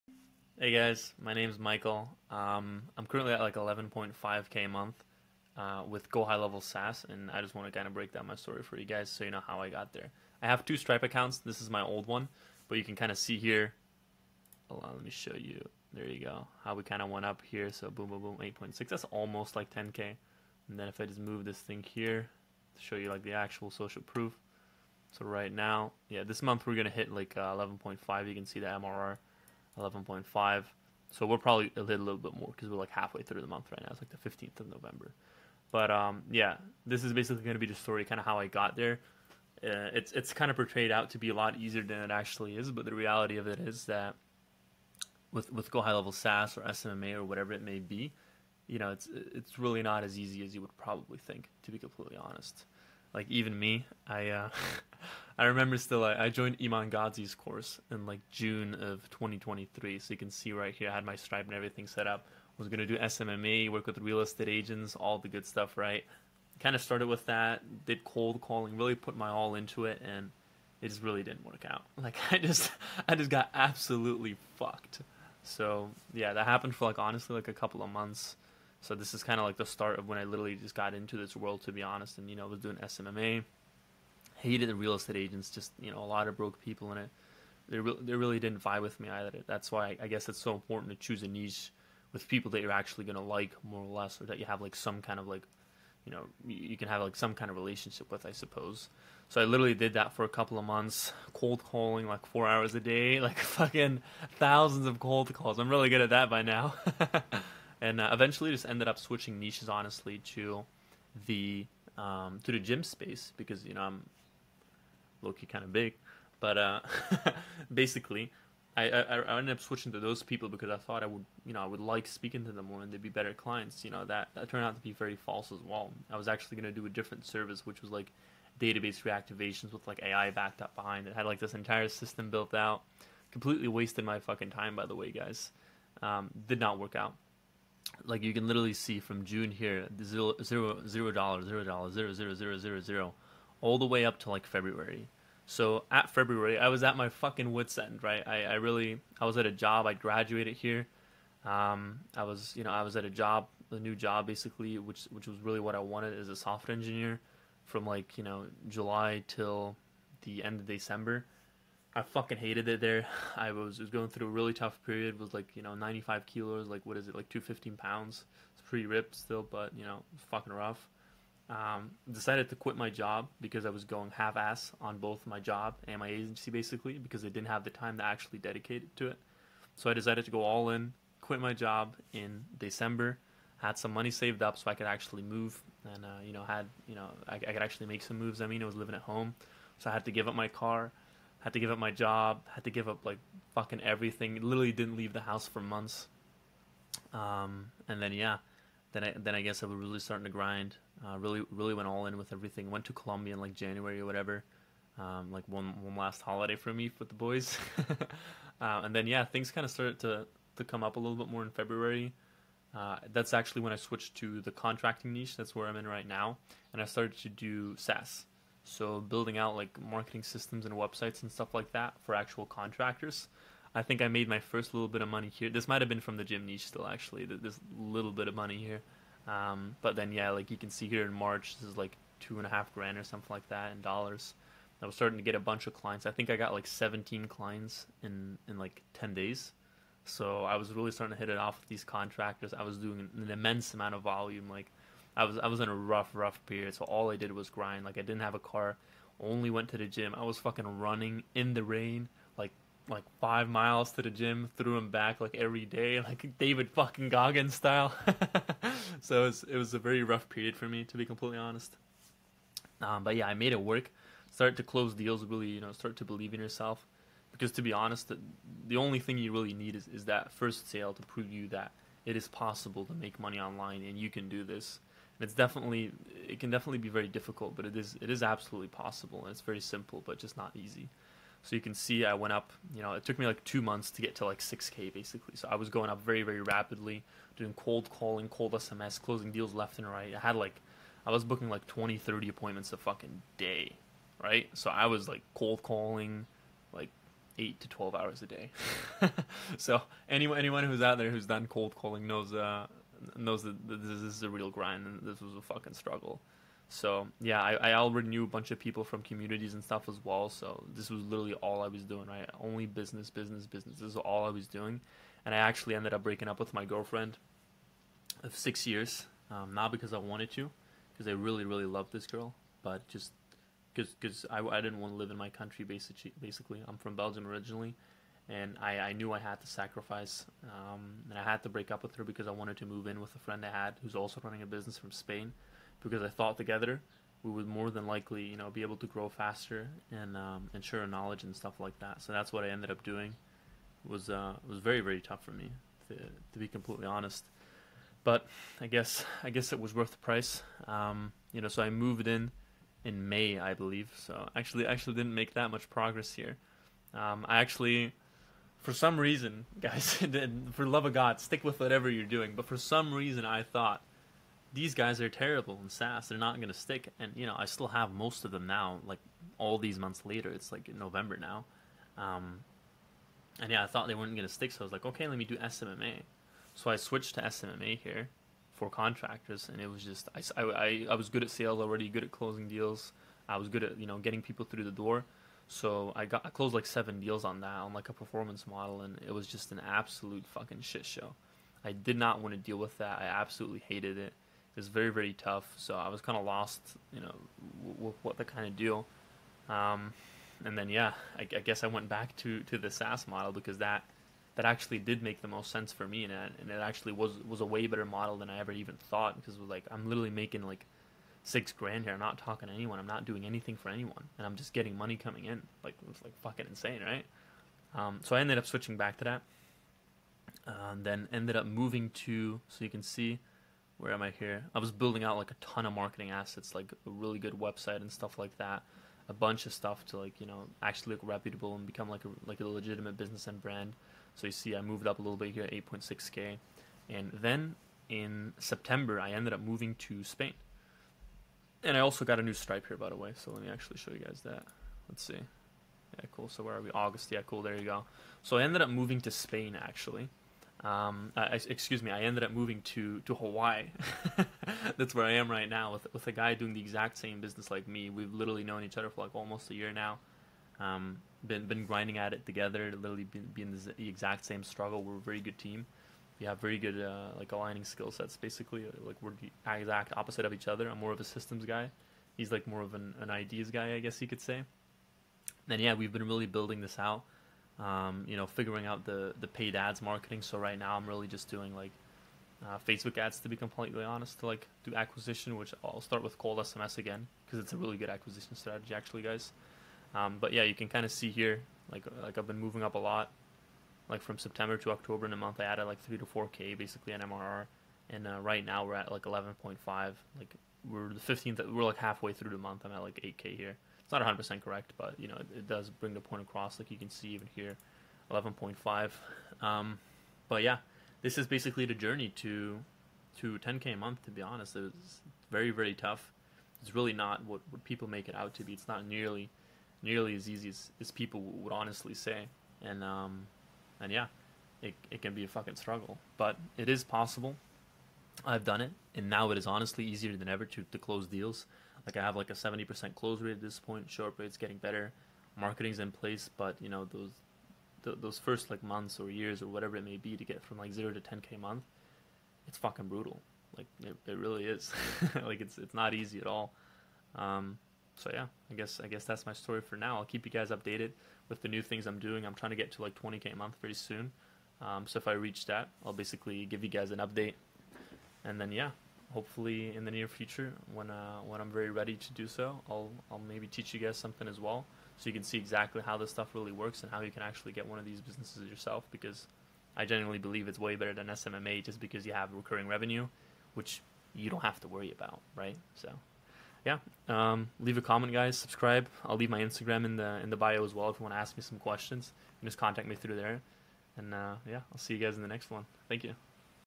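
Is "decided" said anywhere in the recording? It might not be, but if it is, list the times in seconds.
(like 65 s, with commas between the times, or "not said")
172 s, 179 s.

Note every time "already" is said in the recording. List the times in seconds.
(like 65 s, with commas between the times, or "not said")
307 s, 381 s.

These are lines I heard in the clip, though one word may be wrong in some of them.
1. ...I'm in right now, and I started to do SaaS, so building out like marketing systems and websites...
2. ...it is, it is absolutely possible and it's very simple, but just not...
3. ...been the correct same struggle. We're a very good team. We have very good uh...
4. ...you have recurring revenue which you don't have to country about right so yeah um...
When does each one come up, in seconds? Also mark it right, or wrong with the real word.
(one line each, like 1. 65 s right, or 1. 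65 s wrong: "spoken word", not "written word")
1. 215 s right
2. 277 s right
3. 463 s wrong: "exact", not "correct"
4. 572 s wrong: "worry", not "country".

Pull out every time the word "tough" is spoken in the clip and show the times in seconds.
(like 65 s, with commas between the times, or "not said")
164 s, 345 s, 395 s, 515 s.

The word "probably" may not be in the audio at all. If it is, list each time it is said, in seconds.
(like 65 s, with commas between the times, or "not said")
31 s, 50 s.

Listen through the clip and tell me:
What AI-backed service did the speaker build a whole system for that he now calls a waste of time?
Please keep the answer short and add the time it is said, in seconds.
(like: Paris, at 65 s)
database reactivations, at 128 s.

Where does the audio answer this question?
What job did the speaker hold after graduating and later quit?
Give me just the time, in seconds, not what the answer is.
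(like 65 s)
156 s.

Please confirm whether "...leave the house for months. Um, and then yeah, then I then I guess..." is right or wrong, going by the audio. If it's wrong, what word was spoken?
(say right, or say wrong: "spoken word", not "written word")
right.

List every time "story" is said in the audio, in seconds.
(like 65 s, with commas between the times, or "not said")
8 s, 37 s, 549 s.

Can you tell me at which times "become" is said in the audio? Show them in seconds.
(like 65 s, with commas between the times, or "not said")
431 s.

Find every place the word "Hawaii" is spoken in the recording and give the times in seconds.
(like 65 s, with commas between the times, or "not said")
453 s.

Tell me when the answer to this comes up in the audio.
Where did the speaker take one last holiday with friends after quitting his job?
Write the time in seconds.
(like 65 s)
202 s.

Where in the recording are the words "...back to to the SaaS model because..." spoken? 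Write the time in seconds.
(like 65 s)
401 s.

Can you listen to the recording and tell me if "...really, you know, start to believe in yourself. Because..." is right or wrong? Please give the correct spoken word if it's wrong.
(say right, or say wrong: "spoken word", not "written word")
right.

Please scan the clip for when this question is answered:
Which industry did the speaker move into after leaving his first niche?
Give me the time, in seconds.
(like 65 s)
112 s.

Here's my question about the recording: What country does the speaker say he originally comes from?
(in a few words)
Belgium.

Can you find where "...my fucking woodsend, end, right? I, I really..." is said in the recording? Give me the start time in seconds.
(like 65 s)
146 s.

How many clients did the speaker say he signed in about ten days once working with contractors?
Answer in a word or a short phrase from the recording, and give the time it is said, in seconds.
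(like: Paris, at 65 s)
17, at 236 s.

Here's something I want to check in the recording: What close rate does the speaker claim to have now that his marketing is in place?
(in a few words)
70%.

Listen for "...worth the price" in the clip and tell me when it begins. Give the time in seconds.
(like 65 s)
349 s.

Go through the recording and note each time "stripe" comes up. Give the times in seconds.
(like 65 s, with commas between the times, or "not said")
10 s, 61 s, 442 s.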